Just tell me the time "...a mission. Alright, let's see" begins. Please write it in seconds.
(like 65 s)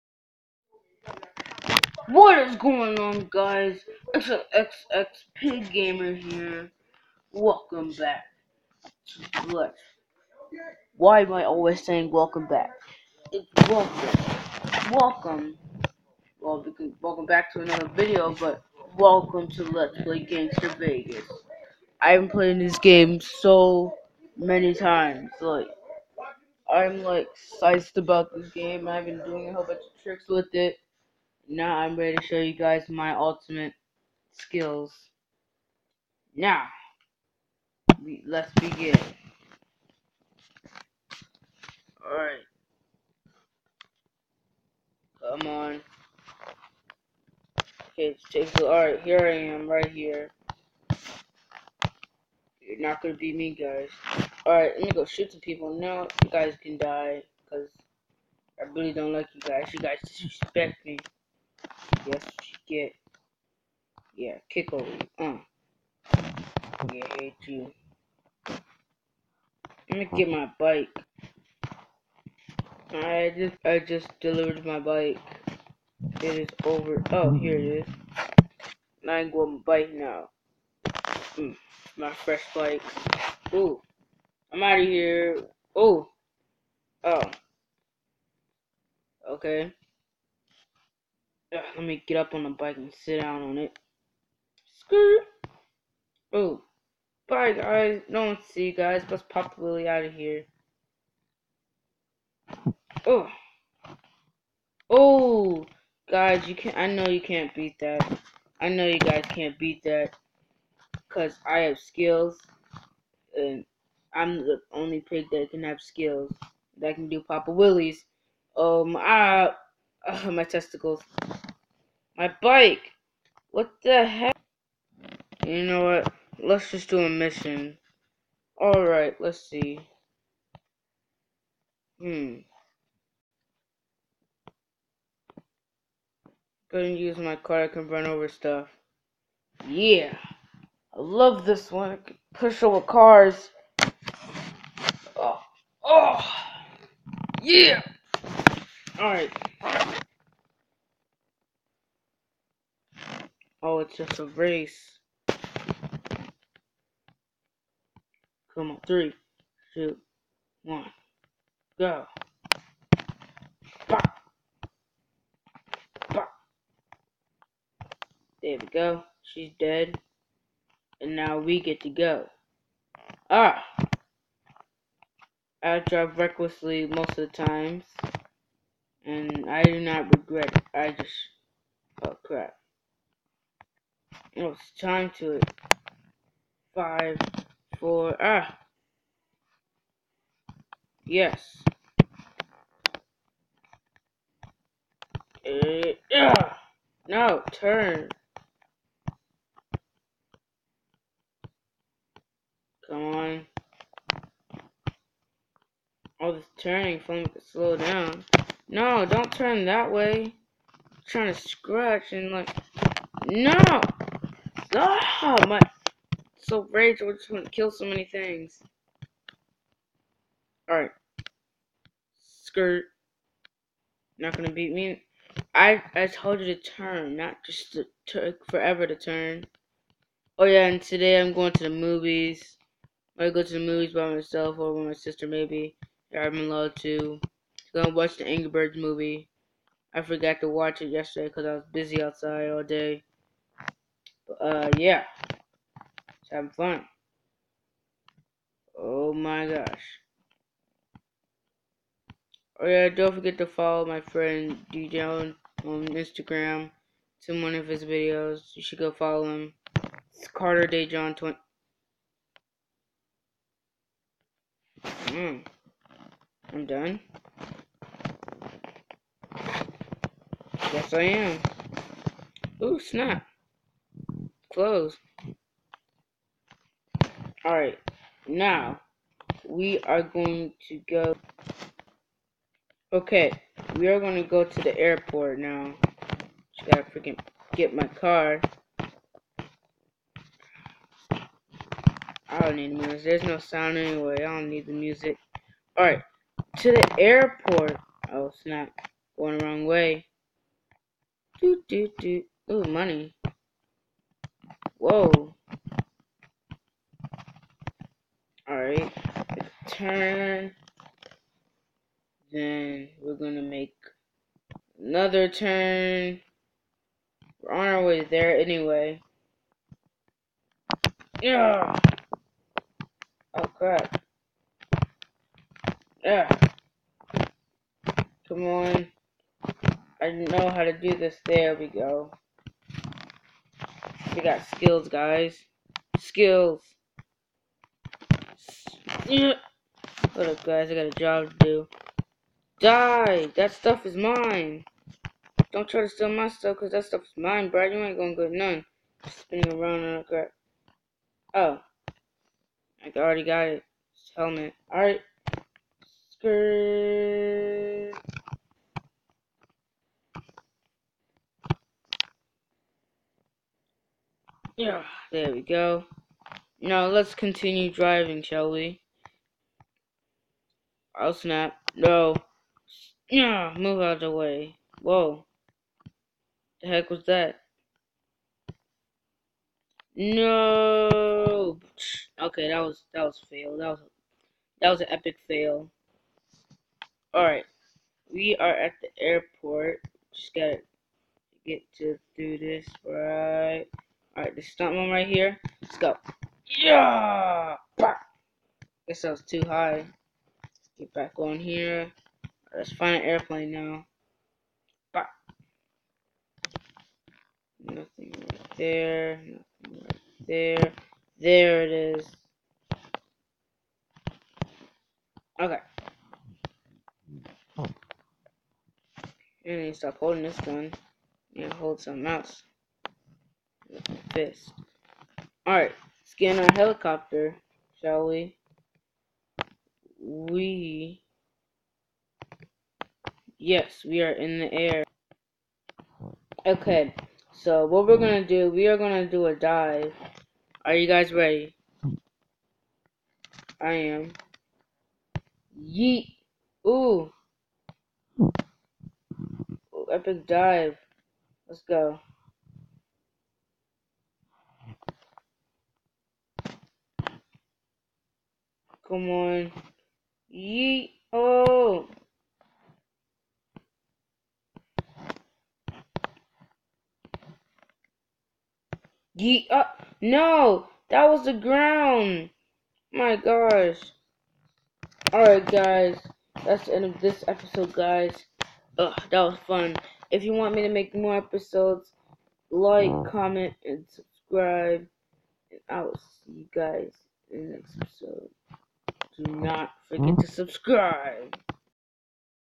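126 s.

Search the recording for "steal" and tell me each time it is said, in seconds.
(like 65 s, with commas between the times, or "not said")
345 s.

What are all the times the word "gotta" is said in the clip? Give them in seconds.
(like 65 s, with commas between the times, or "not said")
286 s, 390 s.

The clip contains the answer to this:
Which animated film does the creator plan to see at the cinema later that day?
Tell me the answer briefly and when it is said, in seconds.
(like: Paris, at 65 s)
The Angry Birds movie, at 238 s.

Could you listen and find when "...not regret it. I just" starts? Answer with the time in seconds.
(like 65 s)
179 s.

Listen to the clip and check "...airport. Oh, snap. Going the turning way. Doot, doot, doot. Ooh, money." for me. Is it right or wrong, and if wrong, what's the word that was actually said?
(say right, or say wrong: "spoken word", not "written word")
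wrong: "wrong", not "turning".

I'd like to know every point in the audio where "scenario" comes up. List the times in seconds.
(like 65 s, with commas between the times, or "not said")
not said.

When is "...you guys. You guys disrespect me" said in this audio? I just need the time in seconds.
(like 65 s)
59 s.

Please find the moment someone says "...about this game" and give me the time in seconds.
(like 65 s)
27 s.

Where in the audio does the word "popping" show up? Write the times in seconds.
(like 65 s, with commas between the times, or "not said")
not said.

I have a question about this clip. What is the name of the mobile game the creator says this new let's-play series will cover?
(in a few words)
Gangstar Vegas.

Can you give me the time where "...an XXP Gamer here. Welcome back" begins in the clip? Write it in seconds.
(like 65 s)
4 s.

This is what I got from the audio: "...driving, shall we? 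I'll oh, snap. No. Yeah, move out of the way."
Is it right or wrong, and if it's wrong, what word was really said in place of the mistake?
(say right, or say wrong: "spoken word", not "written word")
right.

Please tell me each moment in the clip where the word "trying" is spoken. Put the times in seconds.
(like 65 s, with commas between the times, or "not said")
211 s.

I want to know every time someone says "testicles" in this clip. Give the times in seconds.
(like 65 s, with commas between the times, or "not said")
120 s.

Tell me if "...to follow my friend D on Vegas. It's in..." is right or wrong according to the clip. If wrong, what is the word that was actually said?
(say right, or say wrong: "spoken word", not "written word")
wrong: "Instagram", not "Vegas".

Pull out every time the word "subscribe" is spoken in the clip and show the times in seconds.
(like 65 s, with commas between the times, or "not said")
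483 s, 490 s.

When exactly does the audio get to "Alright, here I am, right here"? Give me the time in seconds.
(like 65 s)
48 s.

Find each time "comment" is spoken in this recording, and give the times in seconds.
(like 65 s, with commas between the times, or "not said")
483 s.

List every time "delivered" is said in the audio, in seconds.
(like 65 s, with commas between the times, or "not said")
74 s.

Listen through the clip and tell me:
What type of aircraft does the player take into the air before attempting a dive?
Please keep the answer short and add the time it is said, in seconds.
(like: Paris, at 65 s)
Helicopter, at 426 s.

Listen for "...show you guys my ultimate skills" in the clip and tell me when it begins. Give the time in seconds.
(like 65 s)
32 s.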